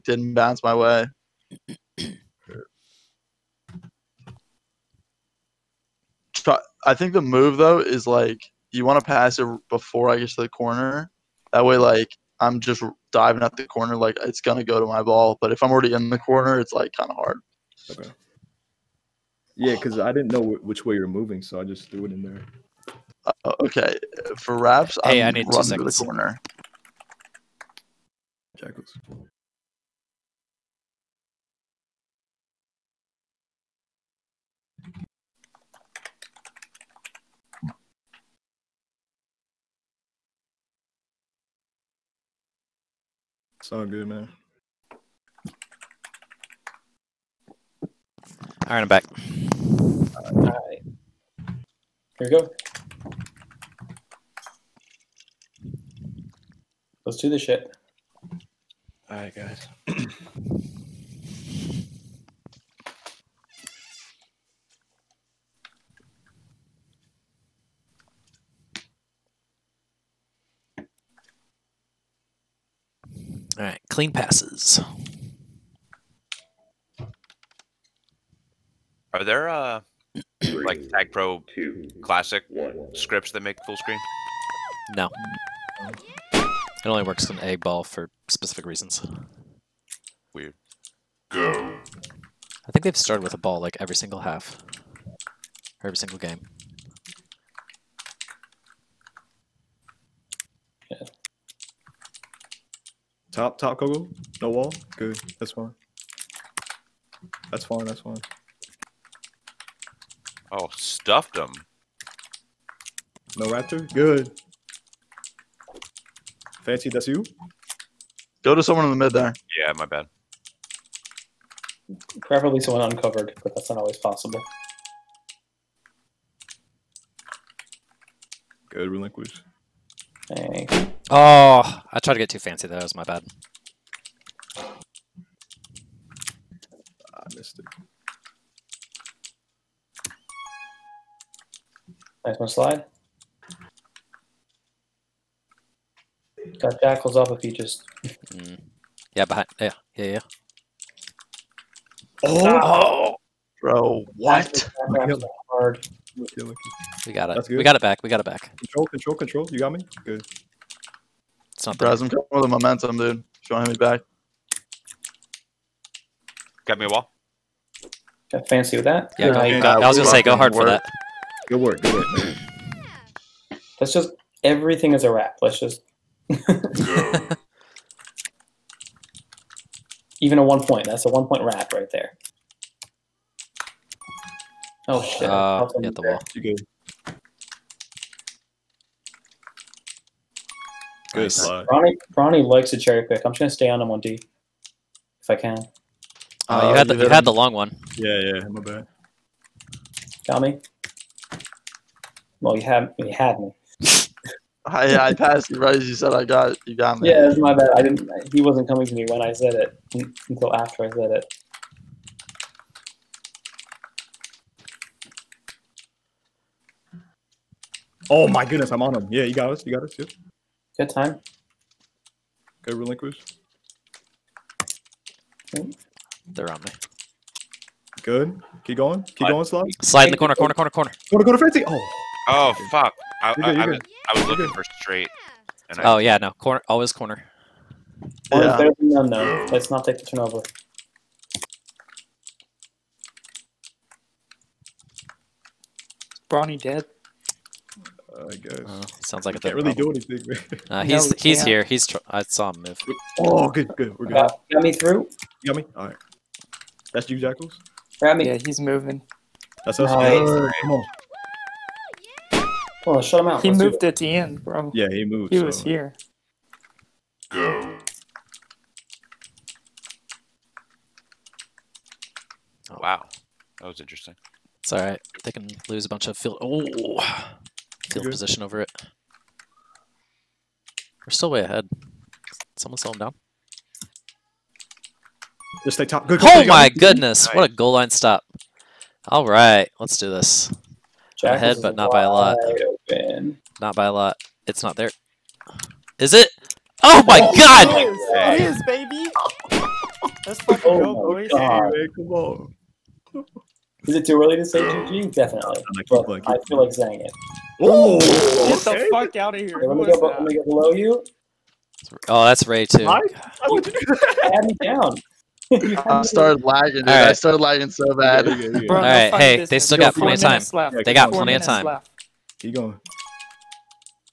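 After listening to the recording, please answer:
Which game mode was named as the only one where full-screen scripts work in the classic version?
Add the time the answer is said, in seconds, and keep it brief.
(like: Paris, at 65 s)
Eggball, at 87 s.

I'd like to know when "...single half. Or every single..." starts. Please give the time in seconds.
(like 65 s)
93 s.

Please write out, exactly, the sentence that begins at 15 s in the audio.
But if I'm already in the corner, it's like kind of hard.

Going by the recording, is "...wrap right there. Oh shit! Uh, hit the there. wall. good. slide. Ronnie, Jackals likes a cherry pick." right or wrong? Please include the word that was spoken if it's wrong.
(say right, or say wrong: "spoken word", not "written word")
wrong: "Ronnie", not "Jackals".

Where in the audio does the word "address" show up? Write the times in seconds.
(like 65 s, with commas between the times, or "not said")
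not said.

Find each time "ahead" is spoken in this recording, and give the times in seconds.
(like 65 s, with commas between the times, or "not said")
281 s, 291 s.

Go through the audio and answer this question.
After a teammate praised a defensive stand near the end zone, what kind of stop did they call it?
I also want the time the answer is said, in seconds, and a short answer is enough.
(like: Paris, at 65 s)
goal line stop, at 287 s.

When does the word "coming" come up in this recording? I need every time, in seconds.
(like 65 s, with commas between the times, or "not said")
162 s, 208 s.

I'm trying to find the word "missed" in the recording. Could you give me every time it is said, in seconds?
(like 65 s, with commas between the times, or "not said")
137 s.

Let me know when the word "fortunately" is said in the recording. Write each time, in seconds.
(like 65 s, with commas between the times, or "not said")
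not said.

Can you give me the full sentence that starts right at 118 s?
Go to someone in the mid there.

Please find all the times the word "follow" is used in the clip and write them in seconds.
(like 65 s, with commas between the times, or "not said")
not said.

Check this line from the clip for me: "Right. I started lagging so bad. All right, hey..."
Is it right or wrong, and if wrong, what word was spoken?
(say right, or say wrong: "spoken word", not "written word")
right.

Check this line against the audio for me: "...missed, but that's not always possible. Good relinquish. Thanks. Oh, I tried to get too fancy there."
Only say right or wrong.
wrong.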